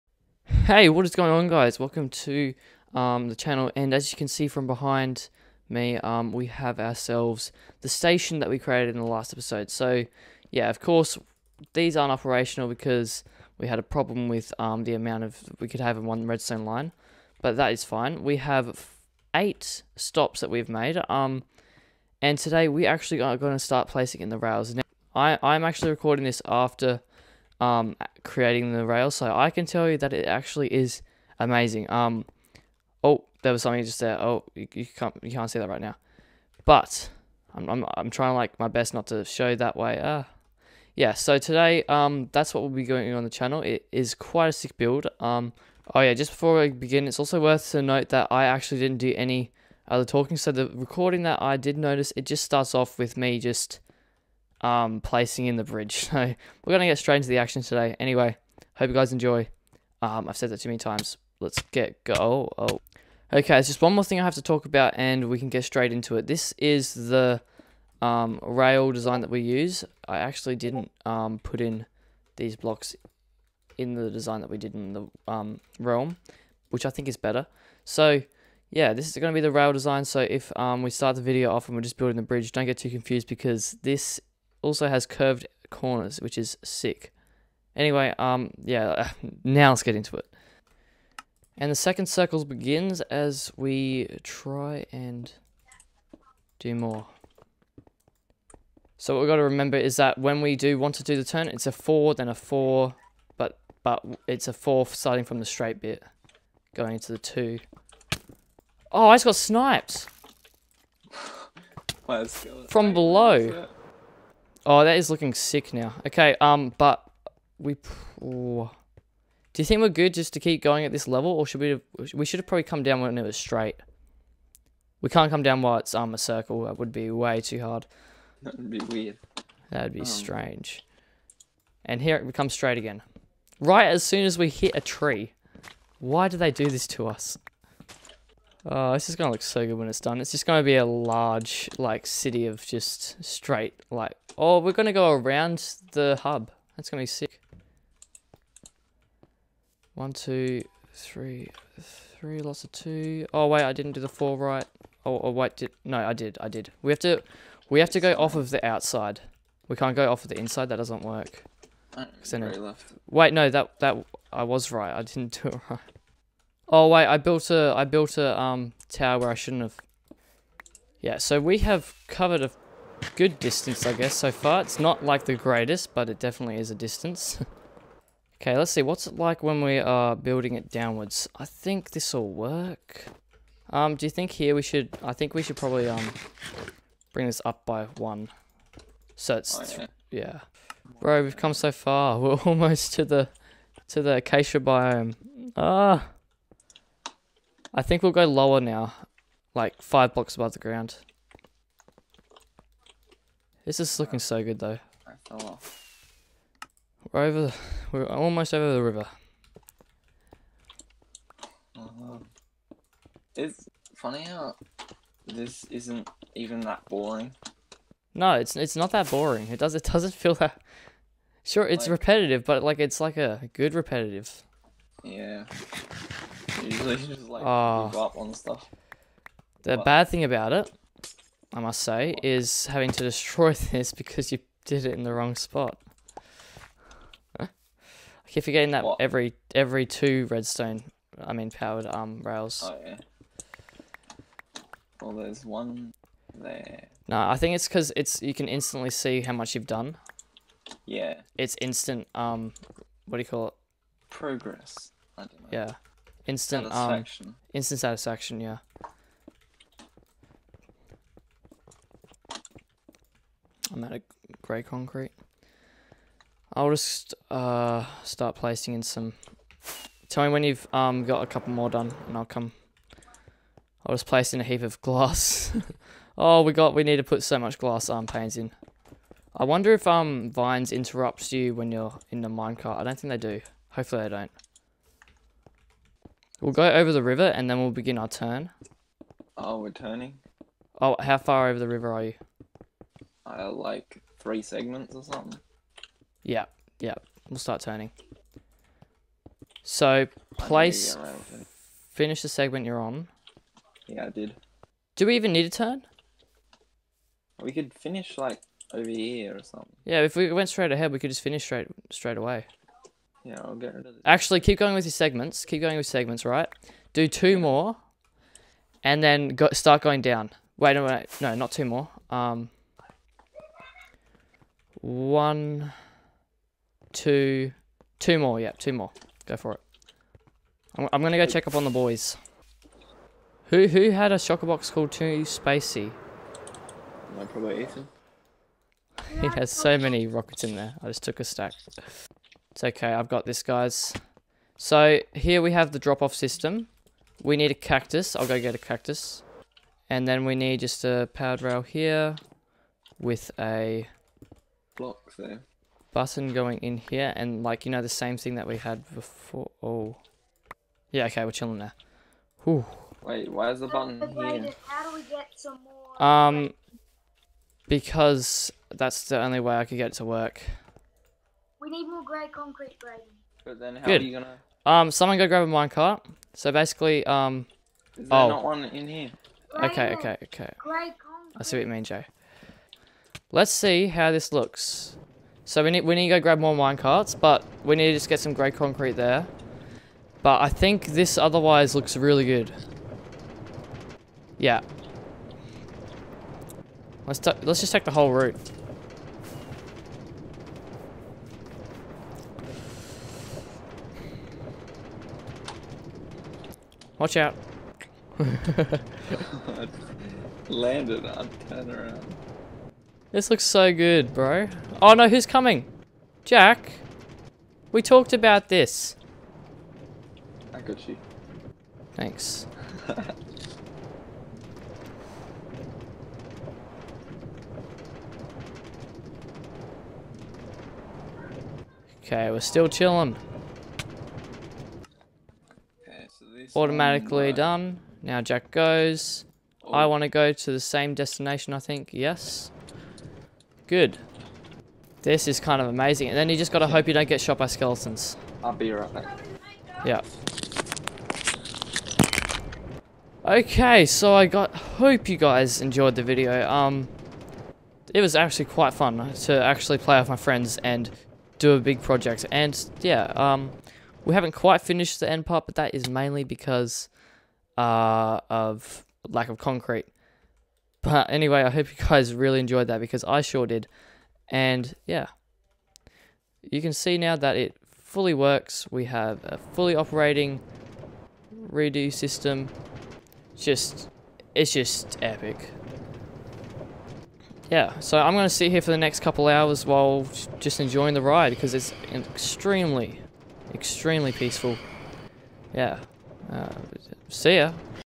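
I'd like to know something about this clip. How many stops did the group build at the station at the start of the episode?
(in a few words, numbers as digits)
8.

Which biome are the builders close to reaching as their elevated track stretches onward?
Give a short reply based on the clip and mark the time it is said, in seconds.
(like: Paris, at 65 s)
acacia, at 194 s.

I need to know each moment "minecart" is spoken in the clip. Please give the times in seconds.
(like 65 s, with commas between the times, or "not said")
282 s, 375 s, 386 s.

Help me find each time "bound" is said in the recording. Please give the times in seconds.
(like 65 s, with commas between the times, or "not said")
not said.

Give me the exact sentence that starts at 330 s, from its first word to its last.
I'm, I'm gonna go check up on the boys.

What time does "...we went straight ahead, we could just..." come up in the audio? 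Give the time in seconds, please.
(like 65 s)
310 s.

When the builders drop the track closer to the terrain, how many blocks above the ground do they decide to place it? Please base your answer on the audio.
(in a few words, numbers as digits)
5.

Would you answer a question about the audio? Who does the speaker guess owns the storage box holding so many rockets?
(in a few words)
Ethan.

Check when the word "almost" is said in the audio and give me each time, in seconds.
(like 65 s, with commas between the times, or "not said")
192 s, 208 s.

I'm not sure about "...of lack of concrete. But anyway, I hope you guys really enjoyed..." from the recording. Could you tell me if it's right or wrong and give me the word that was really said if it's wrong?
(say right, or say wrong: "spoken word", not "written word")
right.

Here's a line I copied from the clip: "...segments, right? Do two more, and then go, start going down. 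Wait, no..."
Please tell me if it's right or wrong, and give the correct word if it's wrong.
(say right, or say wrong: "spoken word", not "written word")
right.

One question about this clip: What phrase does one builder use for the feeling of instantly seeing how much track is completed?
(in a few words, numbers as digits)
Instant satisfaction.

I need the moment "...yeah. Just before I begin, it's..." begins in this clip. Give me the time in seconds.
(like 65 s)
46 s.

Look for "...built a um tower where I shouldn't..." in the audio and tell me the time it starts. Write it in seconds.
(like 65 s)
167 s.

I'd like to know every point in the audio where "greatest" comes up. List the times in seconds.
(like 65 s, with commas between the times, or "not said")
175 s.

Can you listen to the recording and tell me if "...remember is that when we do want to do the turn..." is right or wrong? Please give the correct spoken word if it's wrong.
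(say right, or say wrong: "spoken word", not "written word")
right.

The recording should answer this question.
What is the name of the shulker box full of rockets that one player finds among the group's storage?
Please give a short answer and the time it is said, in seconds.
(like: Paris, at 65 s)
Too Spacey, at 334 s.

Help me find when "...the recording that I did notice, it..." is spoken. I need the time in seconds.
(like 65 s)
50 s.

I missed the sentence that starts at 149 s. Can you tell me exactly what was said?
One, two, three, three, lots of two.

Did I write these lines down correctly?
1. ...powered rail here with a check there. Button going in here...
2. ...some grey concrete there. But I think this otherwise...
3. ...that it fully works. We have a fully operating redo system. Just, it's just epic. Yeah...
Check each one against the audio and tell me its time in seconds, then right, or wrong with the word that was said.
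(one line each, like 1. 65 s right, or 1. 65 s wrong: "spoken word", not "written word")
1. 351 s wrong: "block", not "check"
2. 388 s right
3. 477 s right.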